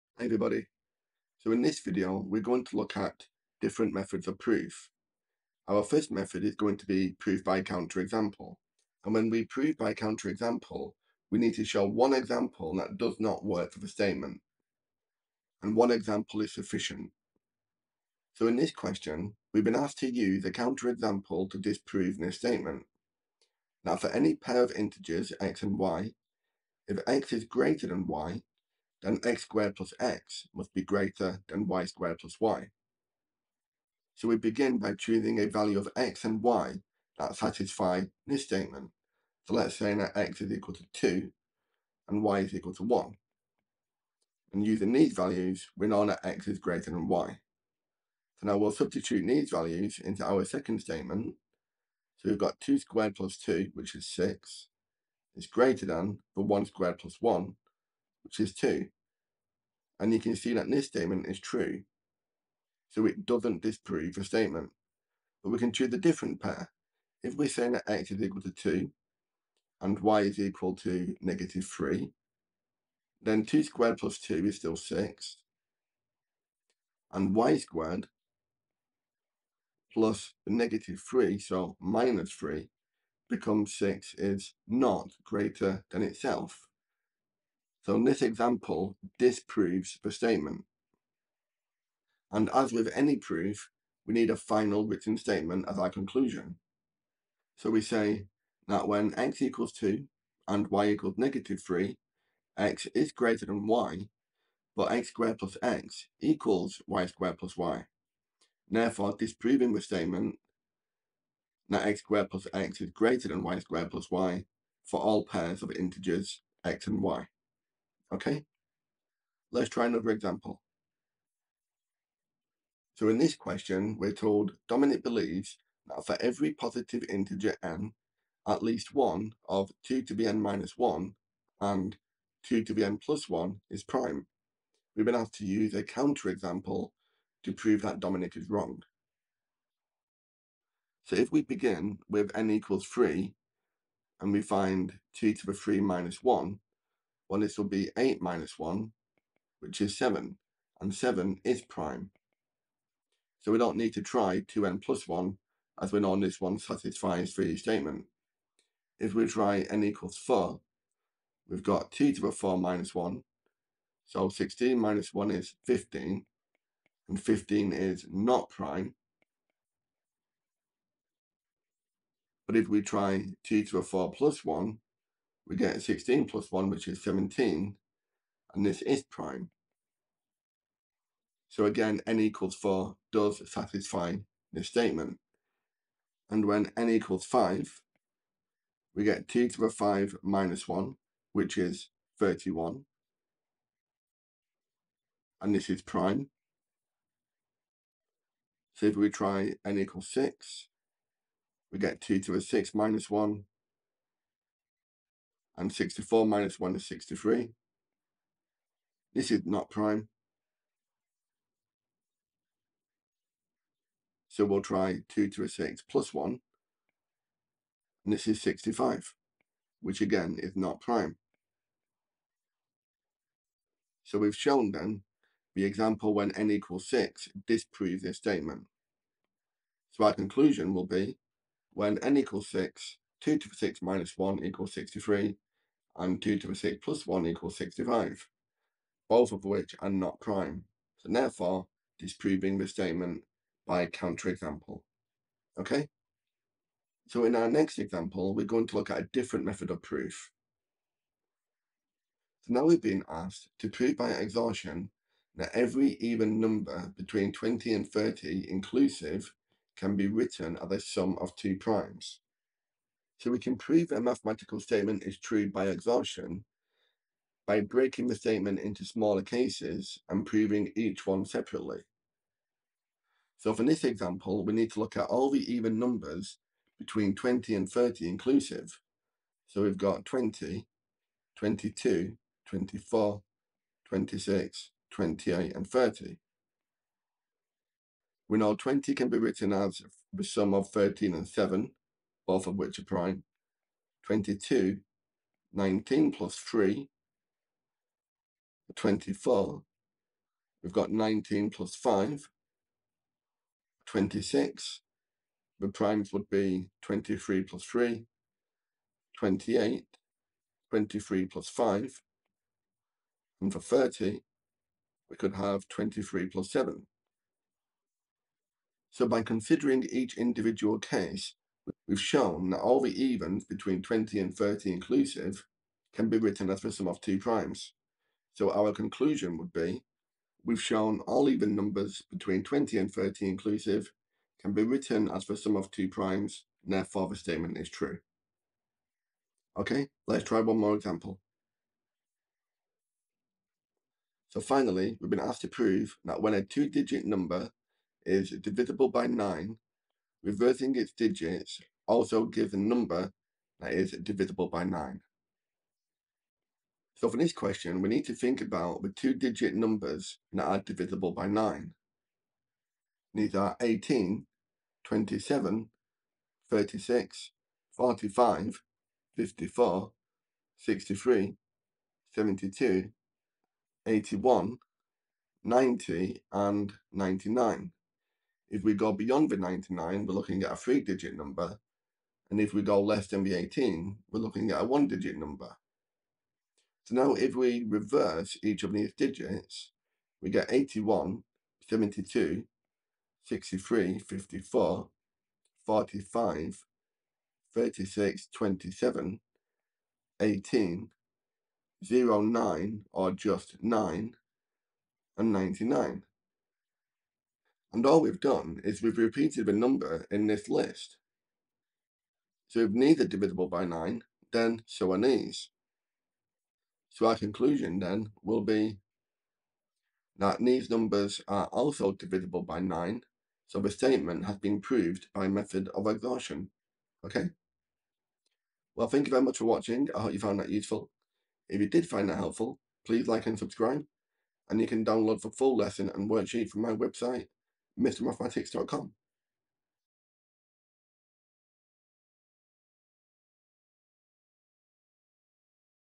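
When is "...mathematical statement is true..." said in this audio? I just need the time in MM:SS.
04:24.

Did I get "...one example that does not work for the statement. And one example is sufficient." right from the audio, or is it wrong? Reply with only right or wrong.
right.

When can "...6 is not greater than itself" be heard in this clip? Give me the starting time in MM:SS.
01:23.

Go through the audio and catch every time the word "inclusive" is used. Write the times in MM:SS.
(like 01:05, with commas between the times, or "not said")
04:18, 04:38, 05:24, 05:33.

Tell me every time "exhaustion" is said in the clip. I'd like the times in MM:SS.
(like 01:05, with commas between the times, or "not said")
04:14, 04:25, 07:05.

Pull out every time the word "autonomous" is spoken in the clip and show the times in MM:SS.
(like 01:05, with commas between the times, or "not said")
not said.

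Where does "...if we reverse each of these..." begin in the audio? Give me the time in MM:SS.
06:27.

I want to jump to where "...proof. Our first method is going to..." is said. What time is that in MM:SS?
00:04.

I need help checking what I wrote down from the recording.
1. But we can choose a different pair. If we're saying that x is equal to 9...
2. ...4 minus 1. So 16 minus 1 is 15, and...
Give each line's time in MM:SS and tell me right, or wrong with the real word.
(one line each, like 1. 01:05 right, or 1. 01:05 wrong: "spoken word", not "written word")
1. 01:05 wrong: "2", not "9"
2. 02:42 right.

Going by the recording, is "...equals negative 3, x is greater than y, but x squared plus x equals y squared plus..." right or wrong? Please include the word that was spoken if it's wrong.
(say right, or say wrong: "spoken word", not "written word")
right.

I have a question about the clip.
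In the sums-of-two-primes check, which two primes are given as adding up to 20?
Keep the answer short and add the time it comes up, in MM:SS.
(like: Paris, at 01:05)
13 and 7, at 04:50.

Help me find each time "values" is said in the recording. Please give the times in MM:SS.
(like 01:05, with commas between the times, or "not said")
00:35, 00:45, 00:49.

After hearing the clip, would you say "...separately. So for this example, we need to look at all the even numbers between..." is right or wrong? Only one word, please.
right.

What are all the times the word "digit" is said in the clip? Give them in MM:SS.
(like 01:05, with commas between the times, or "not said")
05:46, 05:50, 05:58, 06:20, 06:24, 06:28.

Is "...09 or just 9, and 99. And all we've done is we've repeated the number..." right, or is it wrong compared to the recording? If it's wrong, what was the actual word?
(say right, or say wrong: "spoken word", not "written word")
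right.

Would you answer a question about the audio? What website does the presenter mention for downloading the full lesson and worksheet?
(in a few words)
MrMathematics.com.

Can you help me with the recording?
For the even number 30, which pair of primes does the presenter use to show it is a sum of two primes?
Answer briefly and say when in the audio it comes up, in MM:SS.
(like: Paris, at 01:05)
23 plus 7, at 05:15.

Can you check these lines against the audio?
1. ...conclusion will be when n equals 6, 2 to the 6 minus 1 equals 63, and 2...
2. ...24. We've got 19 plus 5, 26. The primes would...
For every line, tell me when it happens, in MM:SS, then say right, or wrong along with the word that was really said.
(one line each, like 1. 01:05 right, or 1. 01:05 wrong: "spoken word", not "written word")
1. 03:50 right
2. 04:58 right.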